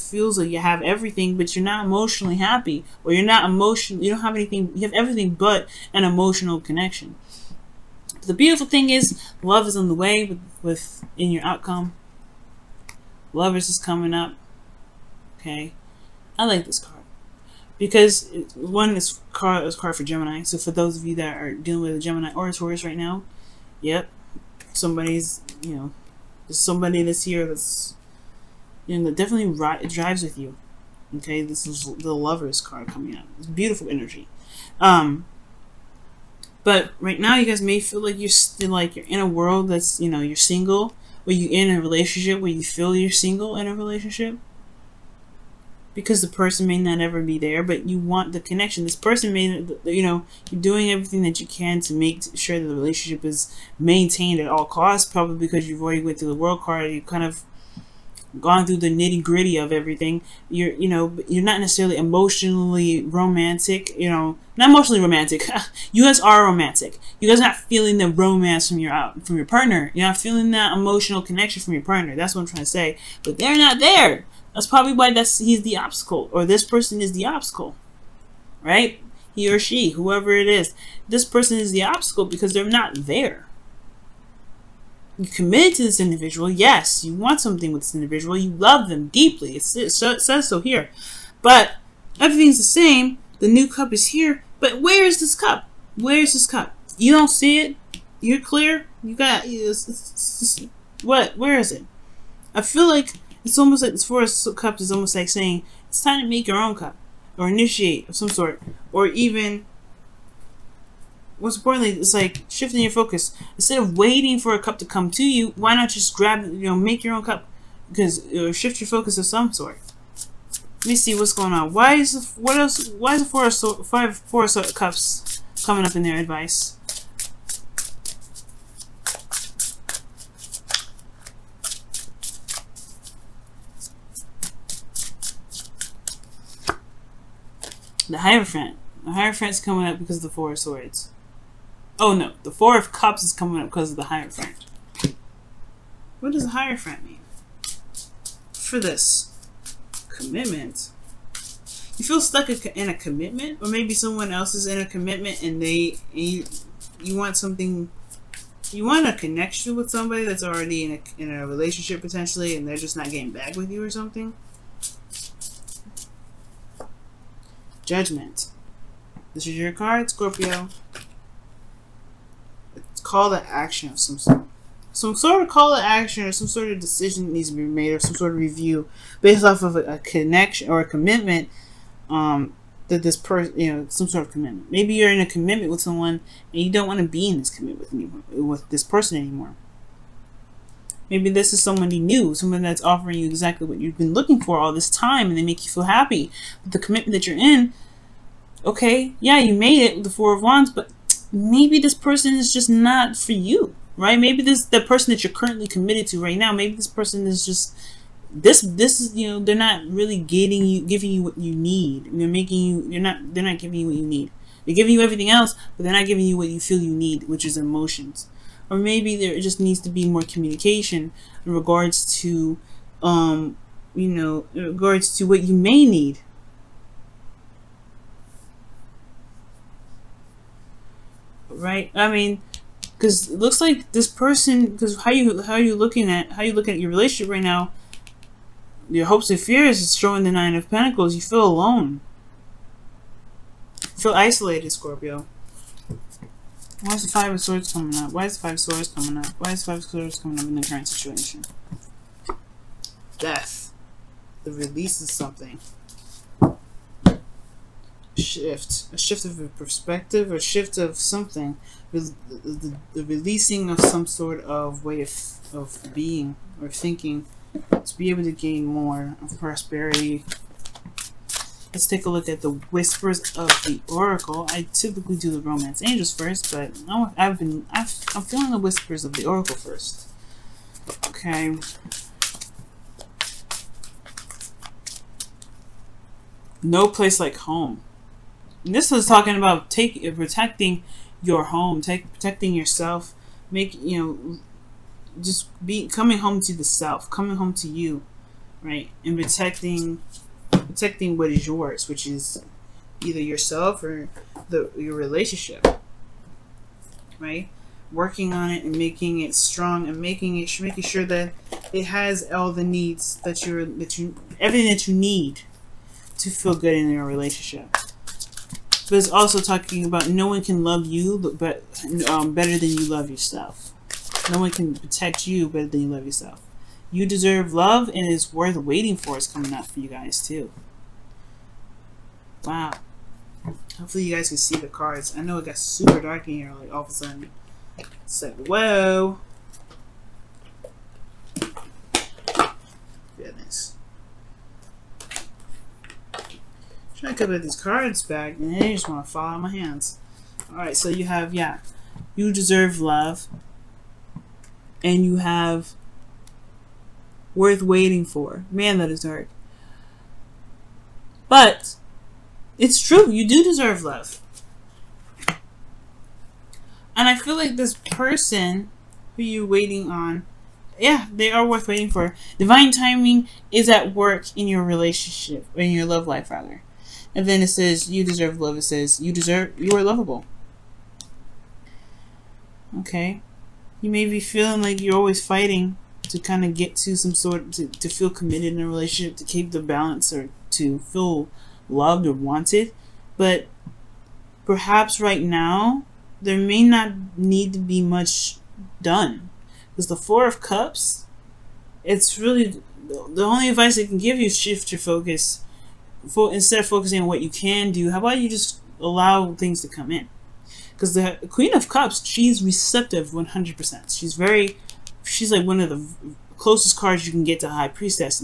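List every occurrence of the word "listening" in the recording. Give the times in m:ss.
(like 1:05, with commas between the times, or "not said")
not said.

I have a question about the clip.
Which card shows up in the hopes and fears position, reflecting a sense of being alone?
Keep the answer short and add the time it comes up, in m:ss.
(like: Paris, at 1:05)
Nine of Pentacles, at 4:00.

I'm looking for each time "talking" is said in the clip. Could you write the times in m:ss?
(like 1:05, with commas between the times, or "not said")
4:49, 5:19.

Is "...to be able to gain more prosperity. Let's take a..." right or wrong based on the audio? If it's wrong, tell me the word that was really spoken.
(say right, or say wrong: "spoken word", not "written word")
right.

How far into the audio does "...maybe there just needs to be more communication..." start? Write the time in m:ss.
3:38.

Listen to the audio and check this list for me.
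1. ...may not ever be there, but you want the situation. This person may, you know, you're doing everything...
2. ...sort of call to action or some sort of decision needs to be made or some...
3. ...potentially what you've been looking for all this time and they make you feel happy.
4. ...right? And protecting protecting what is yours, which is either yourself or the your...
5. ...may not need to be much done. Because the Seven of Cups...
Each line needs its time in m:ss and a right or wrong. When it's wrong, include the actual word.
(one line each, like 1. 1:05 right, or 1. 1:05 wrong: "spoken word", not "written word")
1. 0:46 wrong: "connection", not "situation"
2. 2:55 right
3. 3:13 wrong: "exactly", not "potentially"
4. 4:58 right
5. 6:36 wrong: "Four", not "Seven".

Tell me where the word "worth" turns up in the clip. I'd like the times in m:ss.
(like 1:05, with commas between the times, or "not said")
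5:28, 5:57, 6:11.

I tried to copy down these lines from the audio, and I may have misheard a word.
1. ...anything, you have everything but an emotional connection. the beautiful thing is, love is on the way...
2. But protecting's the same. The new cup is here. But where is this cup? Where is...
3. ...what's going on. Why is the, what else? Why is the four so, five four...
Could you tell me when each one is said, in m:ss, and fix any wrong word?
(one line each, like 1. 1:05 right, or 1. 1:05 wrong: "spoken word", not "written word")
1. 0:04 right
2. 1:31 wrong: "everything", not "protecting"
3. 2:01 right.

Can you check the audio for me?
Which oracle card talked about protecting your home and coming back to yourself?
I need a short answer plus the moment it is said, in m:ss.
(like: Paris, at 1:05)
No Place Like Home, at 4:46.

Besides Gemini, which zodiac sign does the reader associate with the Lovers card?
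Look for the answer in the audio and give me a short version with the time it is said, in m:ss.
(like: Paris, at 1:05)
Taurus, at 0:22.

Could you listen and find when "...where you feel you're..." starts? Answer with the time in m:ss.
0:42.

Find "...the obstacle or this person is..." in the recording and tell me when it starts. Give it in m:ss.
1:15.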